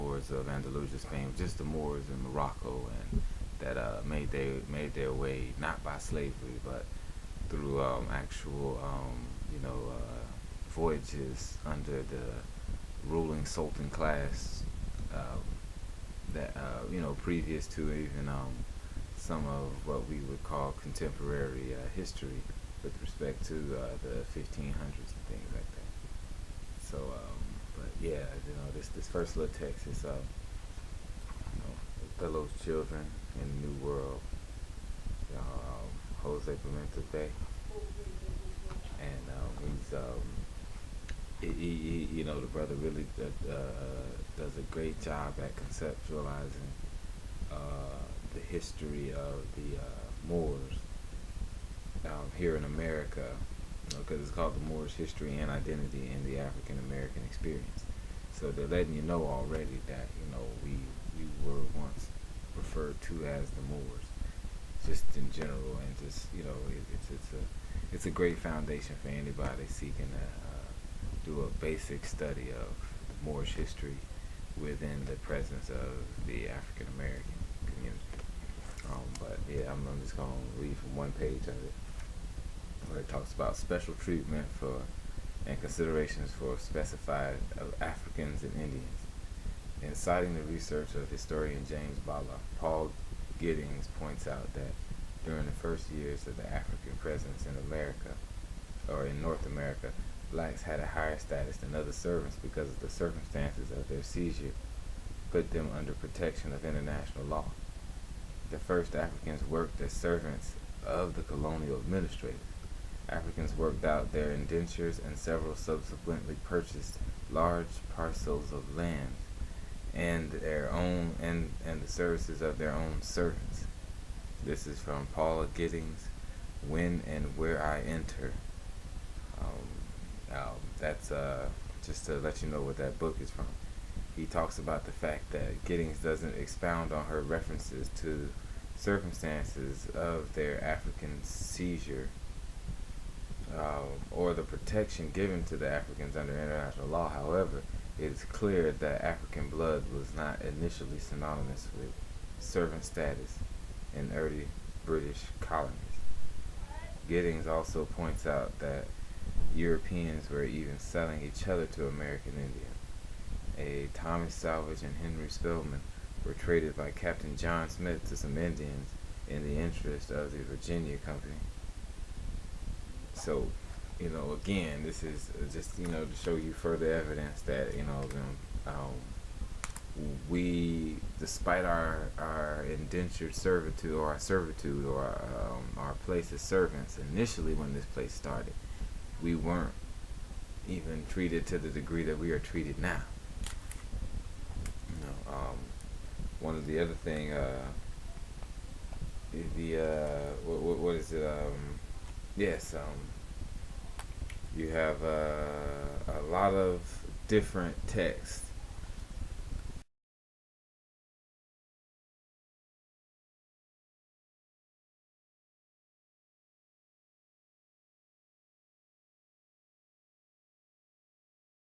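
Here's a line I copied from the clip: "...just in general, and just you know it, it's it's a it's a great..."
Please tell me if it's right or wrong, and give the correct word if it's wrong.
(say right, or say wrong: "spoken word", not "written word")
right.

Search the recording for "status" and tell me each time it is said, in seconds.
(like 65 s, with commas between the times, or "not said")
101 s, 152 s.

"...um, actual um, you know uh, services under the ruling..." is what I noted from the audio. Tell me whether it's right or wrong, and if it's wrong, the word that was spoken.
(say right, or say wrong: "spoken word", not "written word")
wrong: "voyages", not "services".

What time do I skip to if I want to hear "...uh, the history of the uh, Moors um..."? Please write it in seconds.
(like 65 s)
47 s.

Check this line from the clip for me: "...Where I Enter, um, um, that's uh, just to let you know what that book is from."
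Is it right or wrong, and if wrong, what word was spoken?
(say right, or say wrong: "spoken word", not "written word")
right.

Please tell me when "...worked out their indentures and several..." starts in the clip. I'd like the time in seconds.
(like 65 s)
113 s.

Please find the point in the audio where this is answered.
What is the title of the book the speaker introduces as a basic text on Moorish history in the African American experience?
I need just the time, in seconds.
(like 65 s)
32 s.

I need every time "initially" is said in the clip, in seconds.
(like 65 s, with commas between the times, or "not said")
150 s, 187 s.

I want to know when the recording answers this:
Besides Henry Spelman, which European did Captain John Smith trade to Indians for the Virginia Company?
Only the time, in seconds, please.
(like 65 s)
163 s.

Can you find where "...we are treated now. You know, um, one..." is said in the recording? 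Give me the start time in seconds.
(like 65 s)
192 s.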